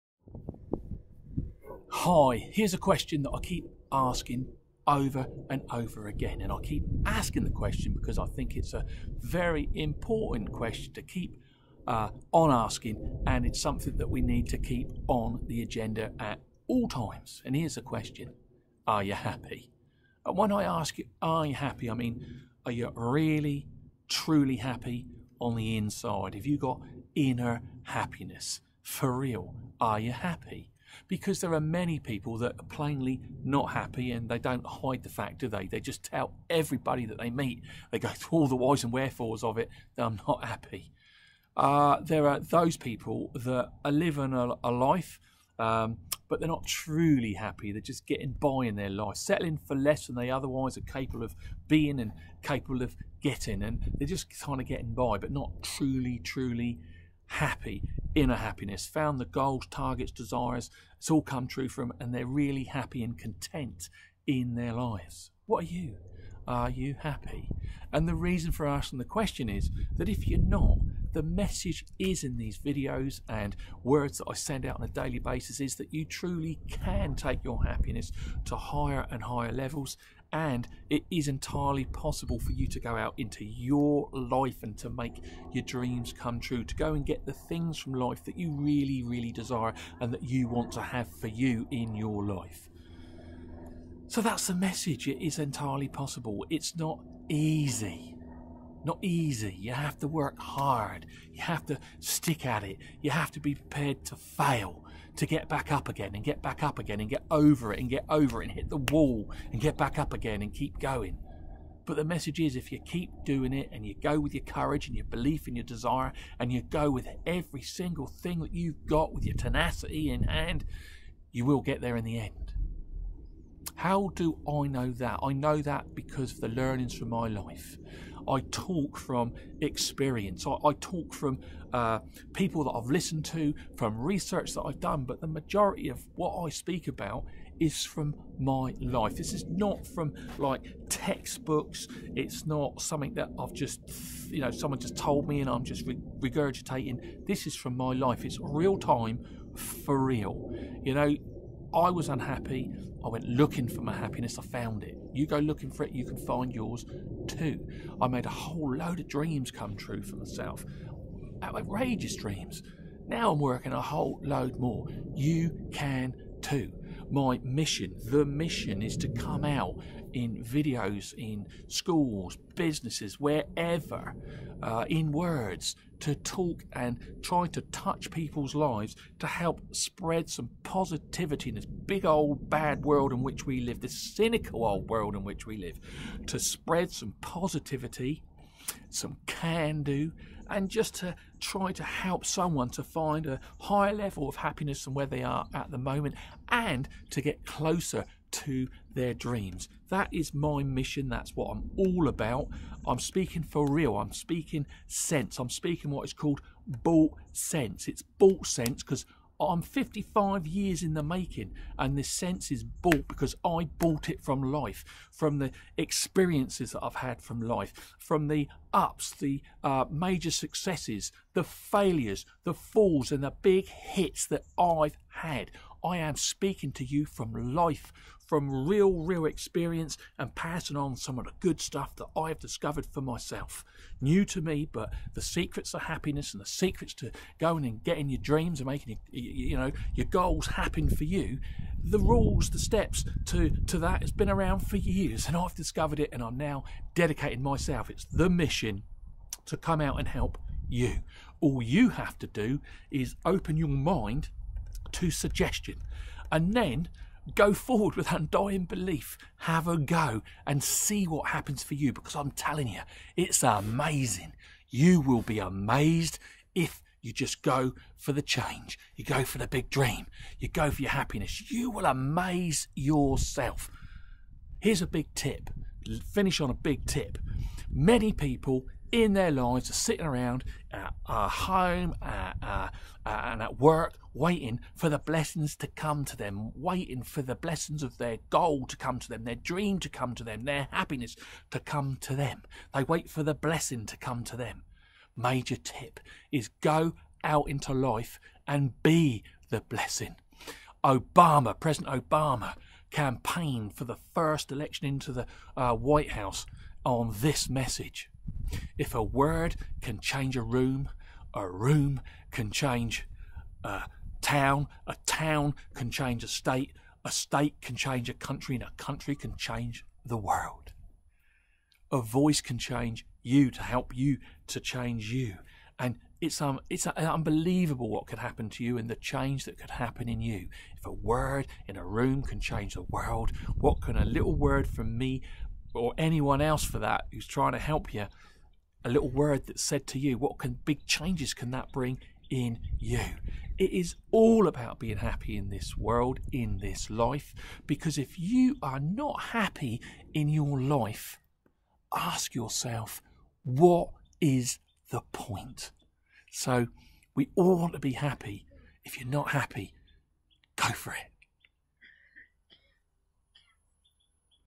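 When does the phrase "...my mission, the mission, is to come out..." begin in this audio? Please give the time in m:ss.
2:47.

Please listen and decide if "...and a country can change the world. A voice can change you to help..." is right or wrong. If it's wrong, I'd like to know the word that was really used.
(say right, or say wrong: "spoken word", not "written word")
right.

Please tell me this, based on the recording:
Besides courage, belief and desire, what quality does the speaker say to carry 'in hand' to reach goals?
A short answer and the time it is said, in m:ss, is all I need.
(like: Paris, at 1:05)
tenacity, at 1:59.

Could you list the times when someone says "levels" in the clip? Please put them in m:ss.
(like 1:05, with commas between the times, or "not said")
1:19, 3:13.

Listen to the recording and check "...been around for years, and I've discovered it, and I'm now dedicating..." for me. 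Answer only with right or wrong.
right.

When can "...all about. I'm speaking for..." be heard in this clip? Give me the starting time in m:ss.
3:21.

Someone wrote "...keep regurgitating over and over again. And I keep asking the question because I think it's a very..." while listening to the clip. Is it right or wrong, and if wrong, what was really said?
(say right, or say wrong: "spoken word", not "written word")
wrong: "asking", not "regurgitating".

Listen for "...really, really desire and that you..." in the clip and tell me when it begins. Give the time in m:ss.
1:28.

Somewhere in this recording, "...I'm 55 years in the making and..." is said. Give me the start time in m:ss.
3:29.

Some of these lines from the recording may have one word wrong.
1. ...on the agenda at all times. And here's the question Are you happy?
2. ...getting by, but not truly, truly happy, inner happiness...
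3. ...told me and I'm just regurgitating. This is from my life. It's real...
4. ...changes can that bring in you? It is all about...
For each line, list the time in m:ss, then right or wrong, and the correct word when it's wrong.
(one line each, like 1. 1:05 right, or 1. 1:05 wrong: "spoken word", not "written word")
1. 0:15 right
2. 0:54 right
3. 2:24 right
4. 5:40 right.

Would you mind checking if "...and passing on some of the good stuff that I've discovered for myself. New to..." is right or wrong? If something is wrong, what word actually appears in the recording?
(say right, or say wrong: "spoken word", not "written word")
right.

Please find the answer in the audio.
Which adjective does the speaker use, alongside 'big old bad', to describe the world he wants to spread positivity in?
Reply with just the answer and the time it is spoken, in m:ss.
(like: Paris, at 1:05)
cynical, at 3:04.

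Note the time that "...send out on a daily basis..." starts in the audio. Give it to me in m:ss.
1:14.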